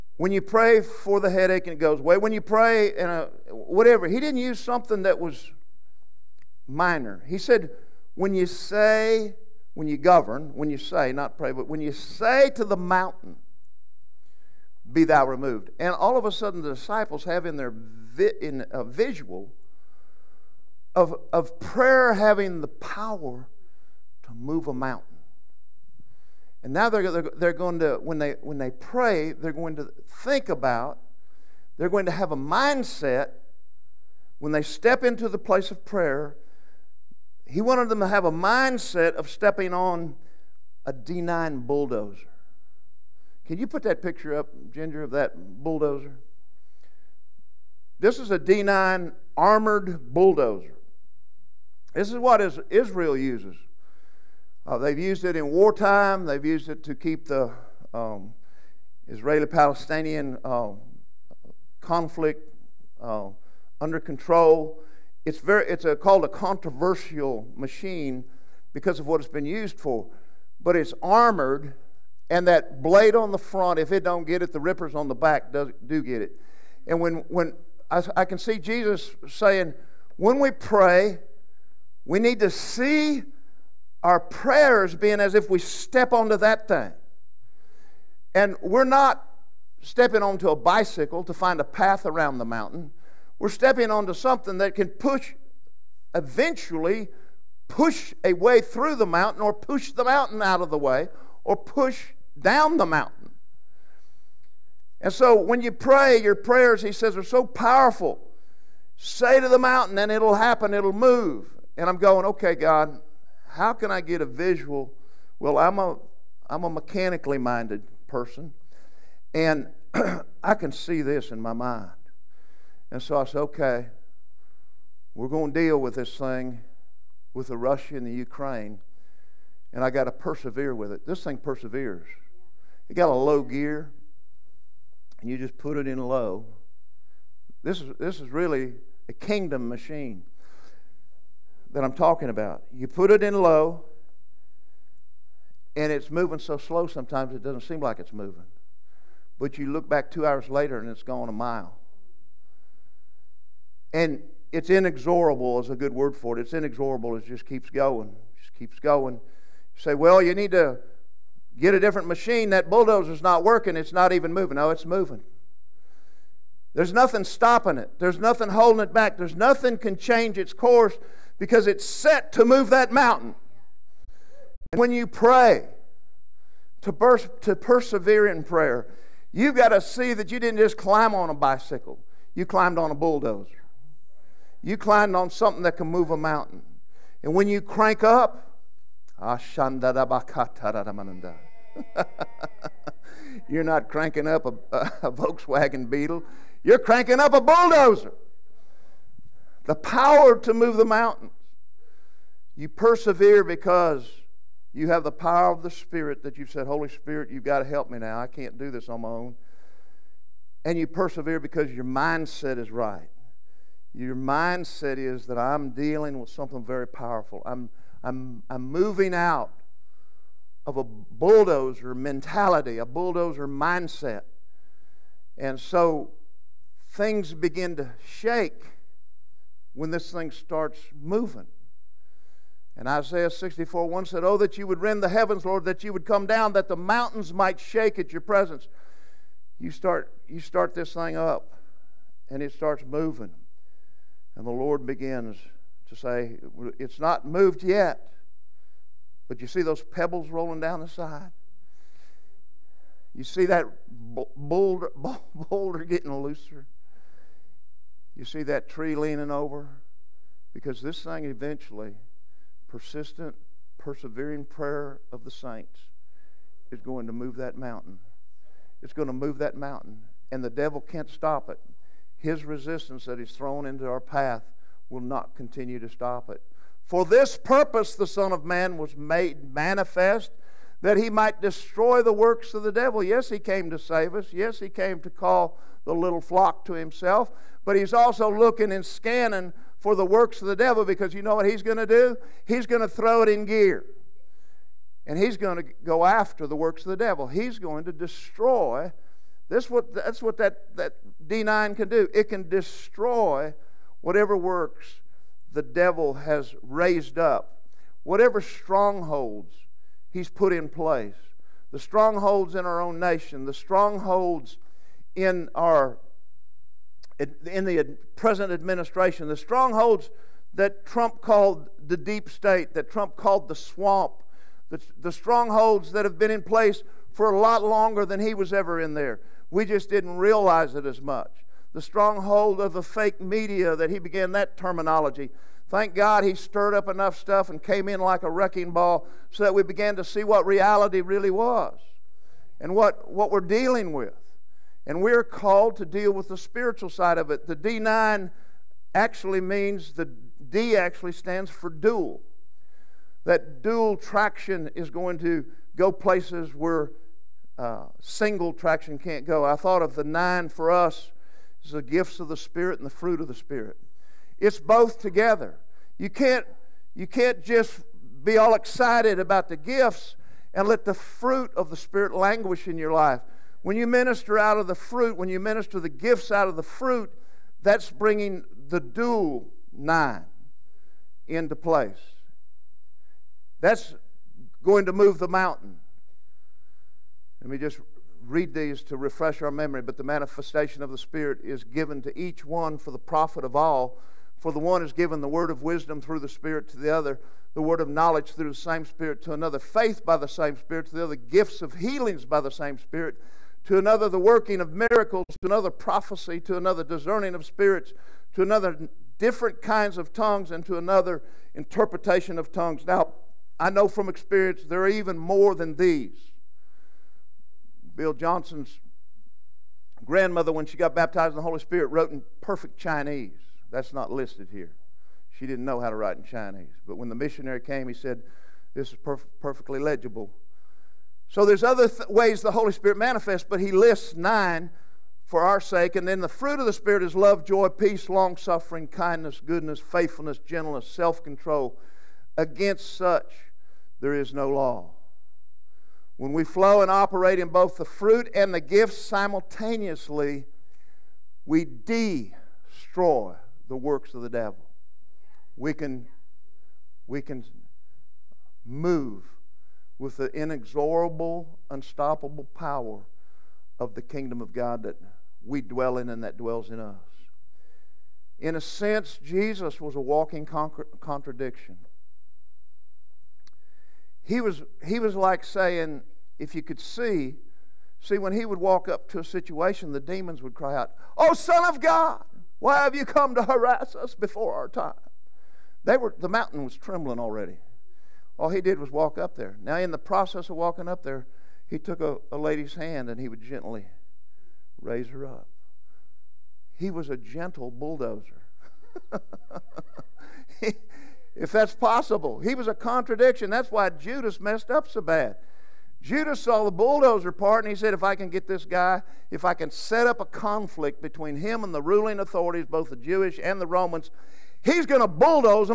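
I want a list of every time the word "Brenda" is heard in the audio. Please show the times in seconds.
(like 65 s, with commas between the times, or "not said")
not said.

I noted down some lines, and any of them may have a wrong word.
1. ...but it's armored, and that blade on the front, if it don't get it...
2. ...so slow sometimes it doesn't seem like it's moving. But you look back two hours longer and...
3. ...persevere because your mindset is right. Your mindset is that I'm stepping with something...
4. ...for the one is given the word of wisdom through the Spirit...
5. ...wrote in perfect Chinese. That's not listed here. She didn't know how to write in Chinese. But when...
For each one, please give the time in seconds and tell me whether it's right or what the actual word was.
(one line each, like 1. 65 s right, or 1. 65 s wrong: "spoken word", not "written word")
1. 70 s right
2. 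146 s wrong: "later", not "longer"
3. 210 s wrong: "dealing", not "stepping"
4. 394 s right
5. 421 s right.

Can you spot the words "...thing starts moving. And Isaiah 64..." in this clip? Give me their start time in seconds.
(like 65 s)
230 s.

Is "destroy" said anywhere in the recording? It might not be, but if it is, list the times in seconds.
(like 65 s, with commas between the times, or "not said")
281 s, 297 s, 302 s, 451 s.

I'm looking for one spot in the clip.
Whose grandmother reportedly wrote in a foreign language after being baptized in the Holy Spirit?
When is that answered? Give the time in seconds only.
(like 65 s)
417 s.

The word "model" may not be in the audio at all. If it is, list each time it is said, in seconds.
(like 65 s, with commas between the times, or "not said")
not said.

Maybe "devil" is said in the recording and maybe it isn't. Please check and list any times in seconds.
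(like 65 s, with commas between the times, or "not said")
270 s, 282 s, 290 s, 296 s, 305 s, 454 s.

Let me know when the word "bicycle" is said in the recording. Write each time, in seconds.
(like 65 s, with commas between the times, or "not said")
90 s, 181 s.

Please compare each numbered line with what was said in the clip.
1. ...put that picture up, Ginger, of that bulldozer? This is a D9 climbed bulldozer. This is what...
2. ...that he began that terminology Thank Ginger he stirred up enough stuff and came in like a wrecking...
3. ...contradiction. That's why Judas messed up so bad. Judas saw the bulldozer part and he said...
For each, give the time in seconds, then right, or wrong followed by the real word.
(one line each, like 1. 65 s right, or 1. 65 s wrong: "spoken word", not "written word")
1. 43 s wrong: "armored", not "climbed"
2. 333 s wrong: "God", not "Ginger"
3. 502 s right.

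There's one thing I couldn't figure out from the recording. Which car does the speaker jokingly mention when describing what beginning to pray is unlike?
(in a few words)
Volkswagen Beetle.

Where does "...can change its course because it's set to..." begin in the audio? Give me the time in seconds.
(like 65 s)
169 s.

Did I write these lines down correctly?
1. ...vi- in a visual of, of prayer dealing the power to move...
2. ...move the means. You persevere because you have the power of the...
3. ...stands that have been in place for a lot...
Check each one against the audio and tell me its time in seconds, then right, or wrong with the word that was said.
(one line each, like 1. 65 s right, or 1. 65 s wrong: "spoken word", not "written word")
1. 17 s wrong: "having", not "dealing"
2. 200 s wrong: "mountains", not "means"
3. 325 s wrong: "strongholds", not "stands".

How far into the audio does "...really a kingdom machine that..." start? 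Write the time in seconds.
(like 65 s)
138 s.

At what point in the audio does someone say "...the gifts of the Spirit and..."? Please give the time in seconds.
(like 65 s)
361 s.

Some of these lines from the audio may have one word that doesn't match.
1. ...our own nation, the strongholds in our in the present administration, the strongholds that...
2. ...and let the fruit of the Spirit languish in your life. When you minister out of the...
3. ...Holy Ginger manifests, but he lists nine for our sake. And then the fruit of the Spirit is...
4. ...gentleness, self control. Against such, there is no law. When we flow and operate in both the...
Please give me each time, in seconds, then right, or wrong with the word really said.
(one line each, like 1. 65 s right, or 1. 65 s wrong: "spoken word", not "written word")
1. 312 s right
2. 370 s right
3. 432 s wrong: "Spirit", not "Ginger"
4. 440 s right.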